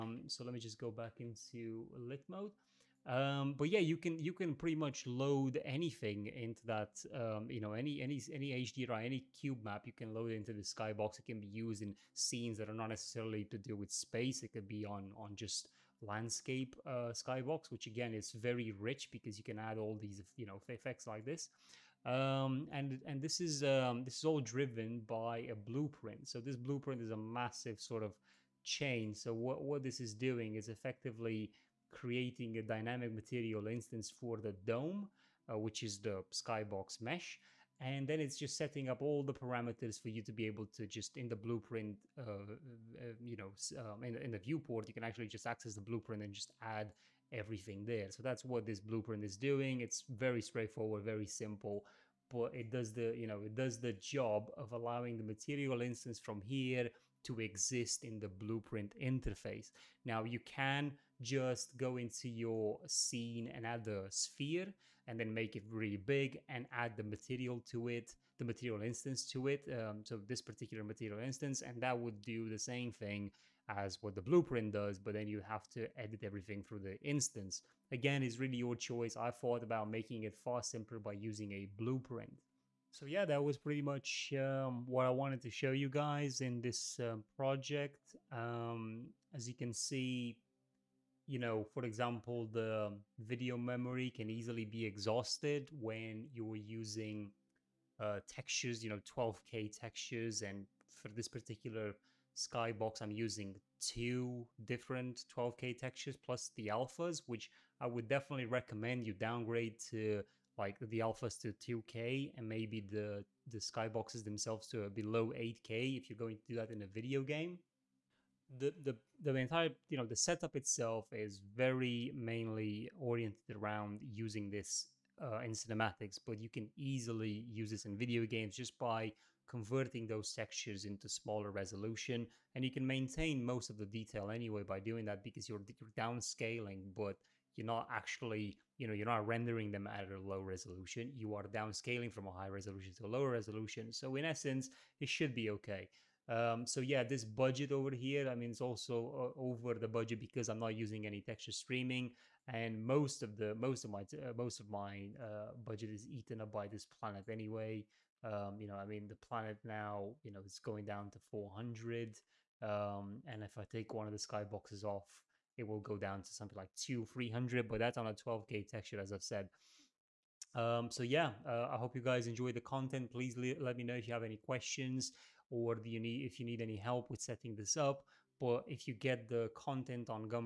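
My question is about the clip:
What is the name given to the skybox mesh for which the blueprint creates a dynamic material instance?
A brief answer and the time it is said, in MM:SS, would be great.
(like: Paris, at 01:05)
the dome, at 00:34.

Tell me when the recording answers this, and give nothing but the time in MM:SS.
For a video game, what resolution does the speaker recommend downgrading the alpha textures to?
01:51.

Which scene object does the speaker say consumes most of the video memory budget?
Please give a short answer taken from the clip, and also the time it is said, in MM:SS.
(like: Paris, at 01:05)
the planet, at 02:36.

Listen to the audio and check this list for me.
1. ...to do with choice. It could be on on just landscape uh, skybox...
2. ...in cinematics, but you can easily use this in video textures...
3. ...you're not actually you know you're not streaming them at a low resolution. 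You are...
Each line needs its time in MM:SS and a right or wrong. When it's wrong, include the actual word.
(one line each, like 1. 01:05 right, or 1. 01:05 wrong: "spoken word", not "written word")
1. 00:13 wrong: "space", not "choice"
2. 02:05 wrong: "games", not "textures"
3. 02:17 wrong: "rendering", not "streaming".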